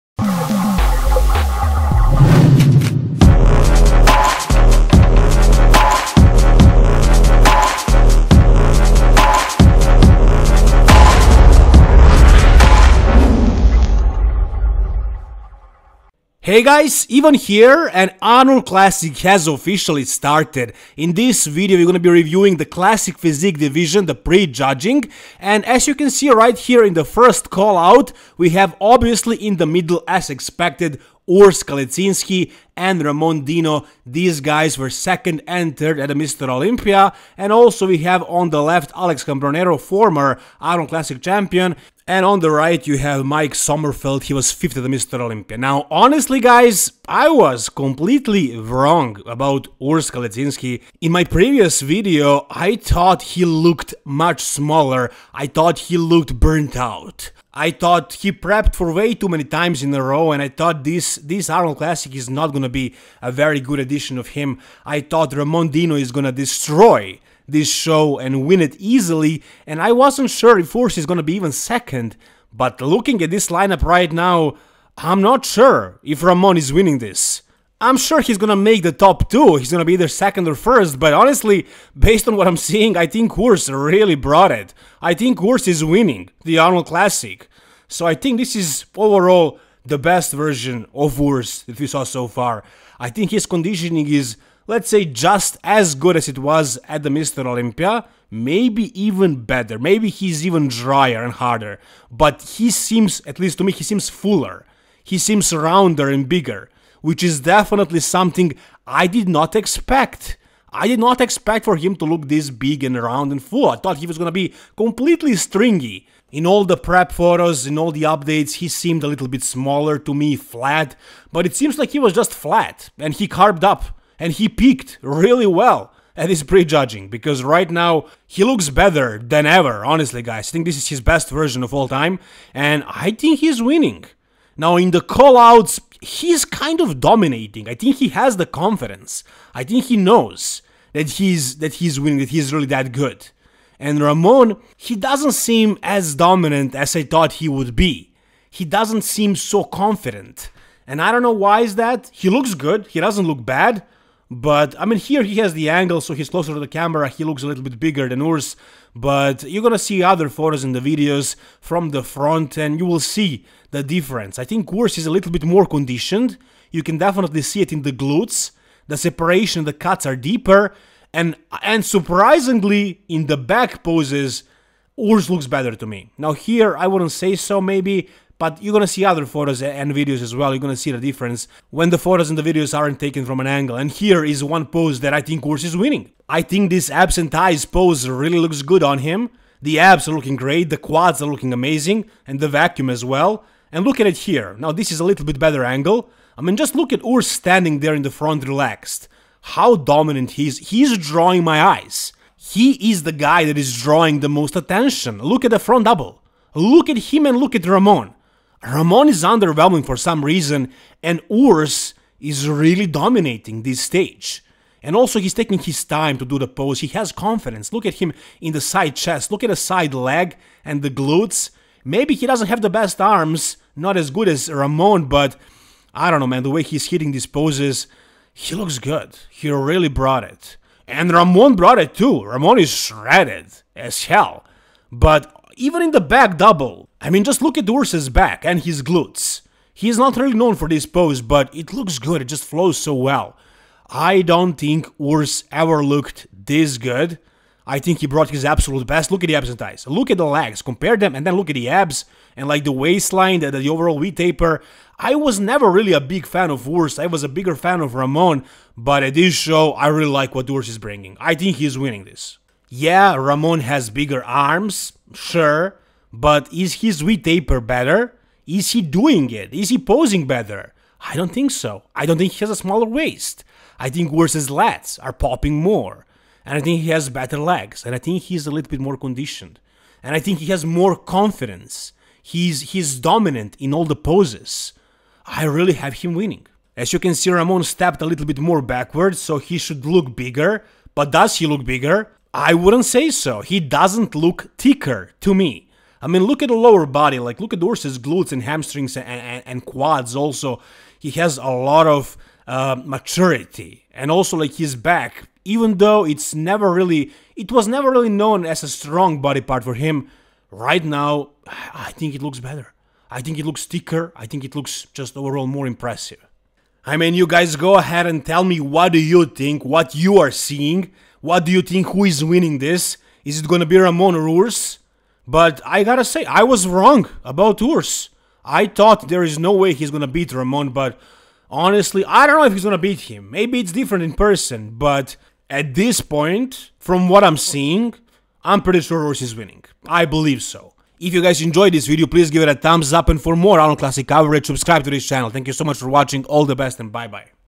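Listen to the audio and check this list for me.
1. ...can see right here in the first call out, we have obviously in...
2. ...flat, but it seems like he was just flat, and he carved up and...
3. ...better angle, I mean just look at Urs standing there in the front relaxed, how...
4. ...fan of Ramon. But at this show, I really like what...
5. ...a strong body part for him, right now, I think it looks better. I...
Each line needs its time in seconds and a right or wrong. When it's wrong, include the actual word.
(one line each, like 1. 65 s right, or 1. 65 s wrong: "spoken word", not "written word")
1. 25 s right
2. 120 s right
3. 195 s right
4. 257 s right
5. 308 s right.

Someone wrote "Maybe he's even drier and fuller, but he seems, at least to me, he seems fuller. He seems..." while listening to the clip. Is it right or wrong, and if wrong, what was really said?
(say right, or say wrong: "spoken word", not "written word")
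wrong: "harder", not "fuller".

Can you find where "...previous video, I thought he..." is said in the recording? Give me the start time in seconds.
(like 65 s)
51 s.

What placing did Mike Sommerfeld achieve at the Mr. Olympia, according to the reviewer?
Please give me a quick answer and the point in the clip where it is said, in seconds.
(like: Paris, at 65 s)
5th, at 44 s.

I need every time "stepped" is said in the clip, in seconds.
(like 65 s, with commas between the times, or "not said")
287 s.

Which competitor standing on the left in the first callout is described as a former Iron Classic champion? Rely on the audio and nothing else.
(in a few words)
Alex Cambronero.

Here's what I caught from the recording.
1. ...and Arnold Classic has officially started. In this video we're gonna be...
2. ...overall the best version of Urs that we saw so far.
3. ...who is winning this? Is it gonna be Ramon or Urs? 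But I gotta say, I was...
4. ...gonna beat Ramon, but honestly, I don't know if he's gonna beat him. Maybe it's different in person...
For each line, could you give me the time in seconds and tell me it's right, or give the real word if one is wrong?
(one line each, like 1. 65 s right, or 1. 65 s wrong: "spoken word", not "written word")
1. 17 s right
2. 88 s right
3. 321 s right
4. 329 s right.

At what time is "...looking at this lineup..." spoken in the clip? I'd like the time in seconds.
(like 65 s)
72 s.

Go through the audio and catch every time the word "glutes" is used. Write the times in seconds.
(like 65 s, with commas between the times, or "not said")
167 s, 220 s, 238 s, 297 s.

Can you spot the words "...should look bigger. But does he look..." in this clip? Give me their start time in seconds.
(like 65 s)
289 s.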